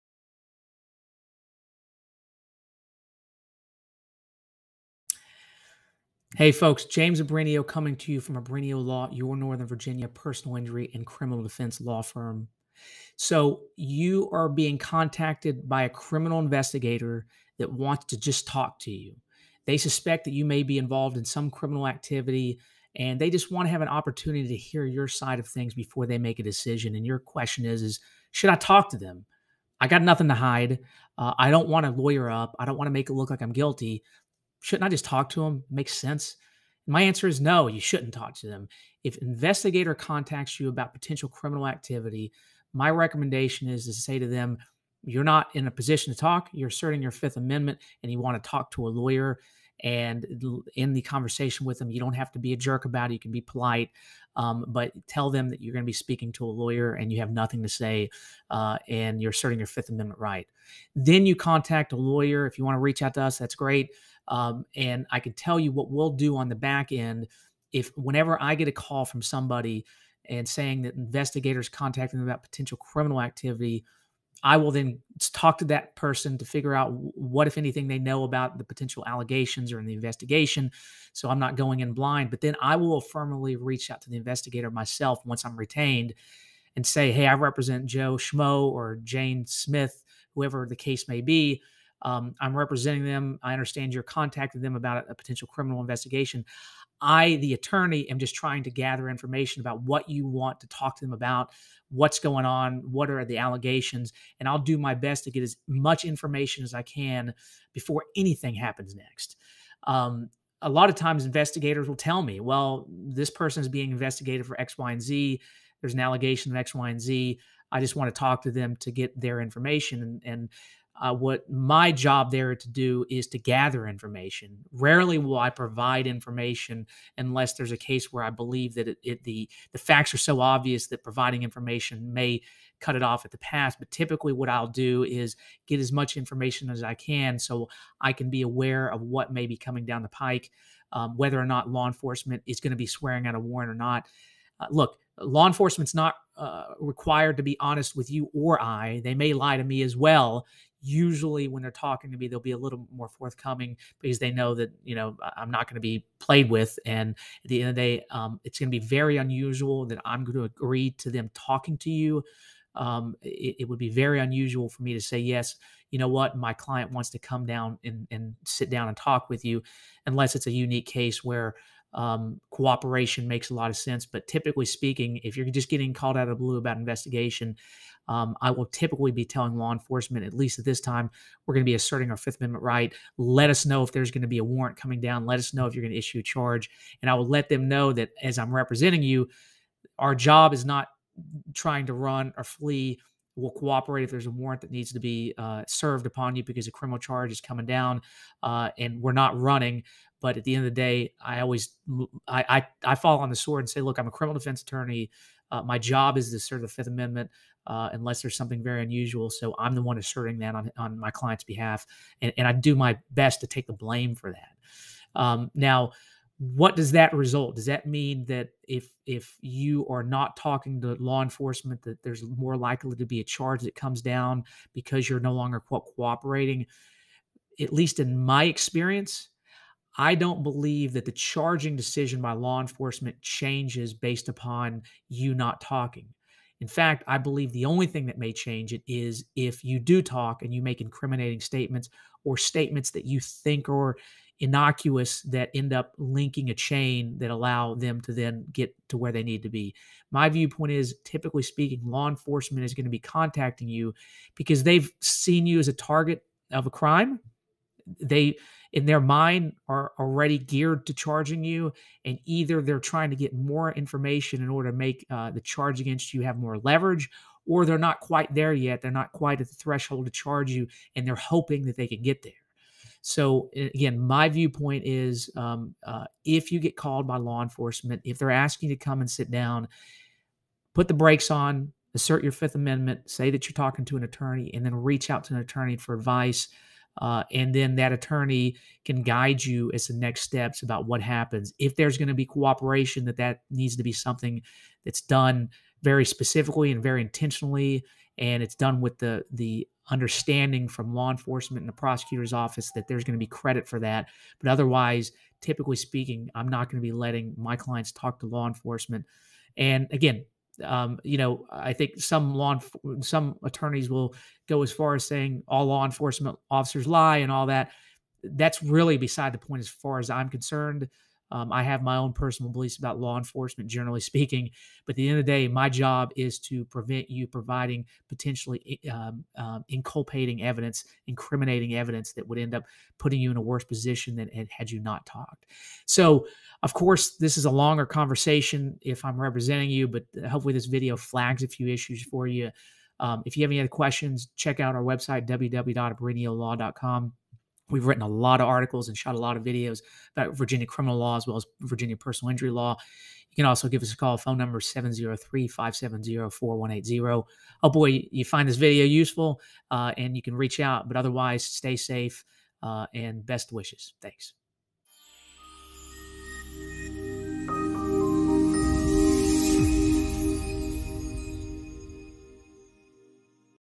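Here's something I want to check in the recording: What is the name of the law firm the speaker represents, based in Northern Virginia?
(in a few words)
Abrenio Law.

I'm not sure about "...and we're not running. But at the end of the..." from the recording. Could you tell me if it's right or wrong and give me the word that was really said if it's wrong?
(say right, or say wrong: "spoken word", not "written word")
right.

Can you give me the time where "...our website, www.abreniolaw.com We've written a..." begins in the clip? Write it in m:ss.
5:44.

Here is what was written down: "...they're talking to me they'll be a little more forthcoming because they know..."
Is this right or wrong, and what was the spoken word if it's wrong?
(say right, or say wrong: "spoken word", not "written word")
right.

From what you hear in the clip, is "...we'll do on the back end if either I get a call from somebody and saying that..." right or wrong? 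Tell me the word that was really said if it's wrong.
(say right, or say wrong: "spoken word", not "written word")
wrong: "whenever", not "either".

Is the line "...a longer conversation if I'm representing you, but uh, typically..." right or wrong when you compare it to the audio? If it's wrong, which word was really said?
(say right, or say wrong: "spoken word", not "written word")
wrong: "hopefully", not "typically".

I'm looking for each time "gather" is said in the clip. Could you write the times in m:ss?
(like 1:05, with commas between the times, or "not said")
1:38, 2:03.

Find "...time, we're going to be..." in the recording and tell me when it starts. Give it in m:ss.
3:00.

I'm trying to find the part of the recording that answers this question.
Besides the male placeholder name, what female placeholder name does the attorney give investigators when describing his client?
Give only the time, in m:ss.
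1:29.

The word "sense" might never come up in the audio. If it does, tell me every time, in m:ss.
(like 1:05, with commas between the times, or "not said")
0:35, 2:53.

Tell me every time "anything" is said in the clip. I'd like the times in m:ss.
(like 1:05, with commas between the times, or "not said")
1:17, 1:48.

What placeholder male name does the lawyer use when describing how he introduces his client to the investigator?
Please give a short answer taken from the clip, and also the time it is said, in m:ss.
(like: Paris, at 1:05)
Joe Schmo, at 1:27.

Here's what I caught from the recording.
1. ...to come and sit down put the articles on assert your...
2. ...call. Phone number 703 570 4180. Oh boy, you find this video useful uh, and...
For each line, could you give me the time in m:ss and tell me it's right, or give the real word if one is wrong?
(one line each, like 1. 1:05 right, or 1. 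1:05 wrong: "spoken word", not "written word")
1. 4:38 wrong: "brakes", not "articles"
2. 5:53 right.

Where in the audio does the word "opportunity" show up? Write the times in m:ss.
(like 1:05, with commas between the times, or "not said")
0:23.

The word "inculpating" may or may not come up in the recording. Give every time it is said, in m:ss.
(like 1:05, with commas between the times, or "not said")
5:29.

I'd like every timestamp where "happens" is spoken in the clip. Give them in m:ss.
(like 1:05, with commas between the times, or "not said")
1:48, 4:51.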